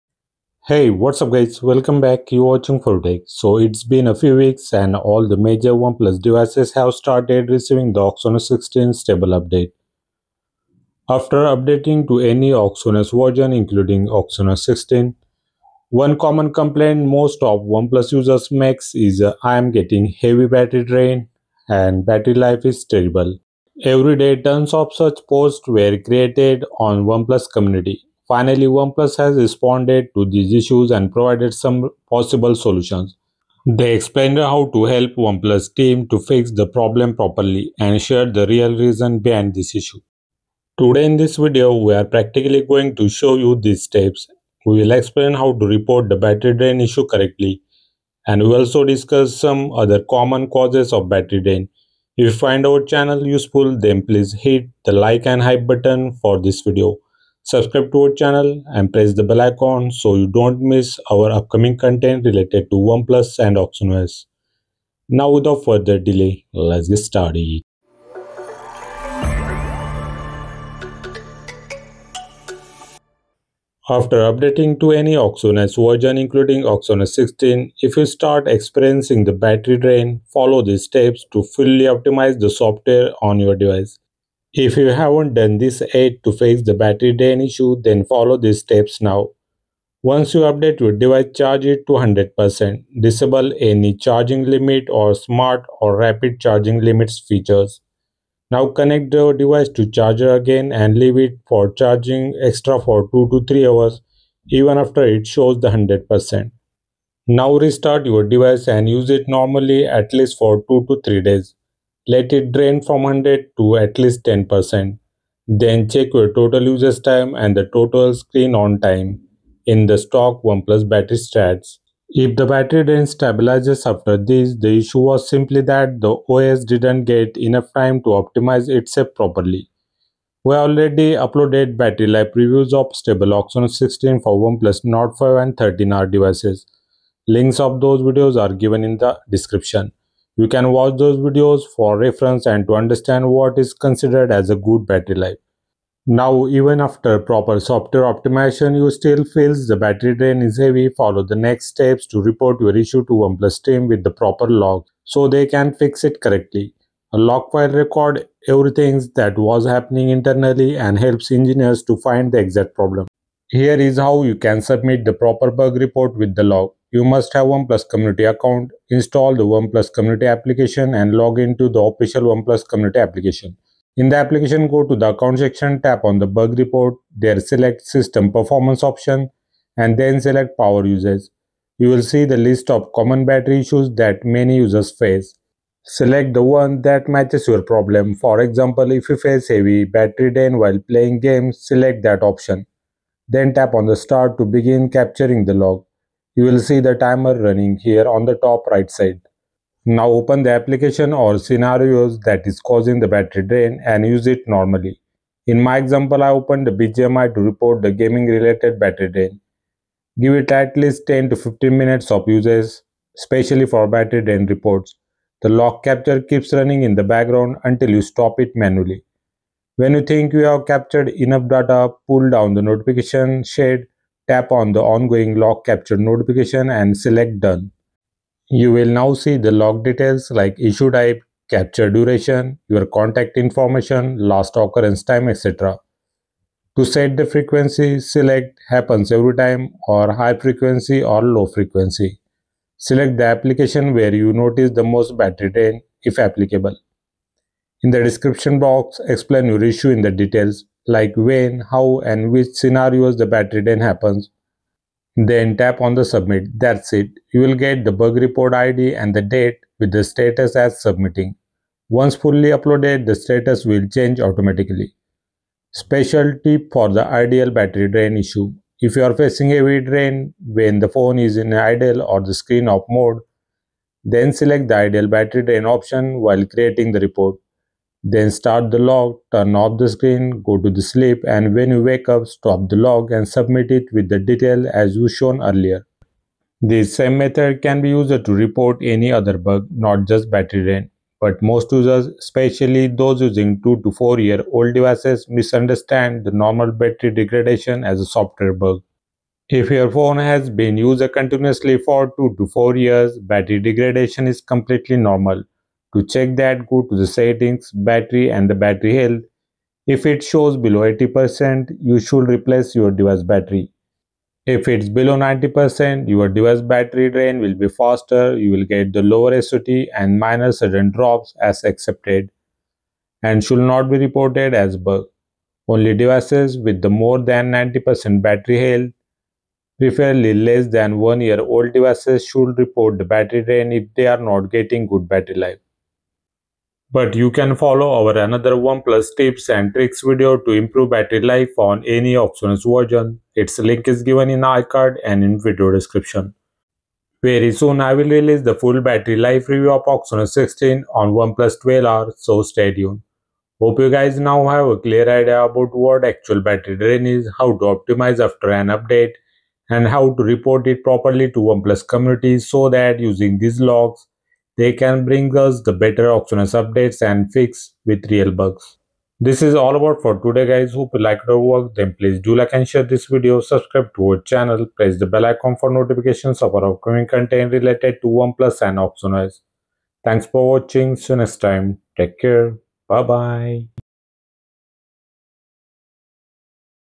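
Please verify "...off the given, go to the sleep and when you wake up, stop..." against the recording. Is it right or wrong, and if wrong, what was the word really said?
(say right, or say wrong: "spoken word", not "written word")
wrong: "screen", not "given".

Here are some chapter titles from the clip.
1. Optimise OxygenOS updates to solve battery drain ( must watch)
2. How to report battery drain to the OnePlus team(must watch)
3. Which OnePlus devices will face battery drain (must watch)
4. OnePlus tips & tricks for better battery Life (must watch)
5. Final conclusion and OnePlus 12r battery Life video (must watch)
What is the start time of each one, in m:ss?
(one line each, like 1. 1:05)
1. 1:13
2. 2:25
3. 4:47
4. 5:36
5. 5:46.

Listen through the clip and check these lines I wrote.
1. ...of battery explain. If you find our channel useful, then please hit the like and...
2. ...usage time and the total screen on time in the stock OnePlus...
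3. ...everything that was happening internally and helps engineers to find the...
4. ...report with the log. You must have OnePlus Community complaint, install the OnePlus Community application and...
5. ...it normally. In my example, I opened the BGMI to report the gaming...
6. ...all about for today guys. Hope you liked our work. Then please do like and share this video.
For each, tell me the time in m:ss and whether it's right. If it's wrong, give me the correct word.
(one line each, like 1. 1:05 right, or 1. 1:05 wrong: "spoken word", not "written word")
1. 0:50 wrong: "drain", not "explain"
2. 1:56 right
3. 2:38 right
4. 2:45 wrong: "account", not "complaint"
5. 3:24 right
6. 6:09 right.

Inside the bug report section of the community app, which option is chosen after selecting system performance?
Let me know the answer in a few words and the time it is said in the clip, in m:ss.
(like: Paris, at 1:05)
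Power usage, at 3:00.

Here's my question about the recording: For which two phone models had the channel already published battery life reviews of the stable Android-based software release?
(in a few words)
Nord 5 and 13R.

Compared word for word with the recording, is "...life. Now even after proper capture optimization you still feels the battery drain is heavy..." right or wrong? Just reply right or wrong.
wrong.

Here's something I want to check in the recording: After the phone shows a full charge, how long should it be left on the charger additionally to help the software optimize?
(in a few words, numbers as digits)
2 to 3 hours.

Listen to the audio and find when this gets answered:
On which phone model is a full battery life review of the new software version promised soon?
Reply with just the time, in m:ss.
5:51.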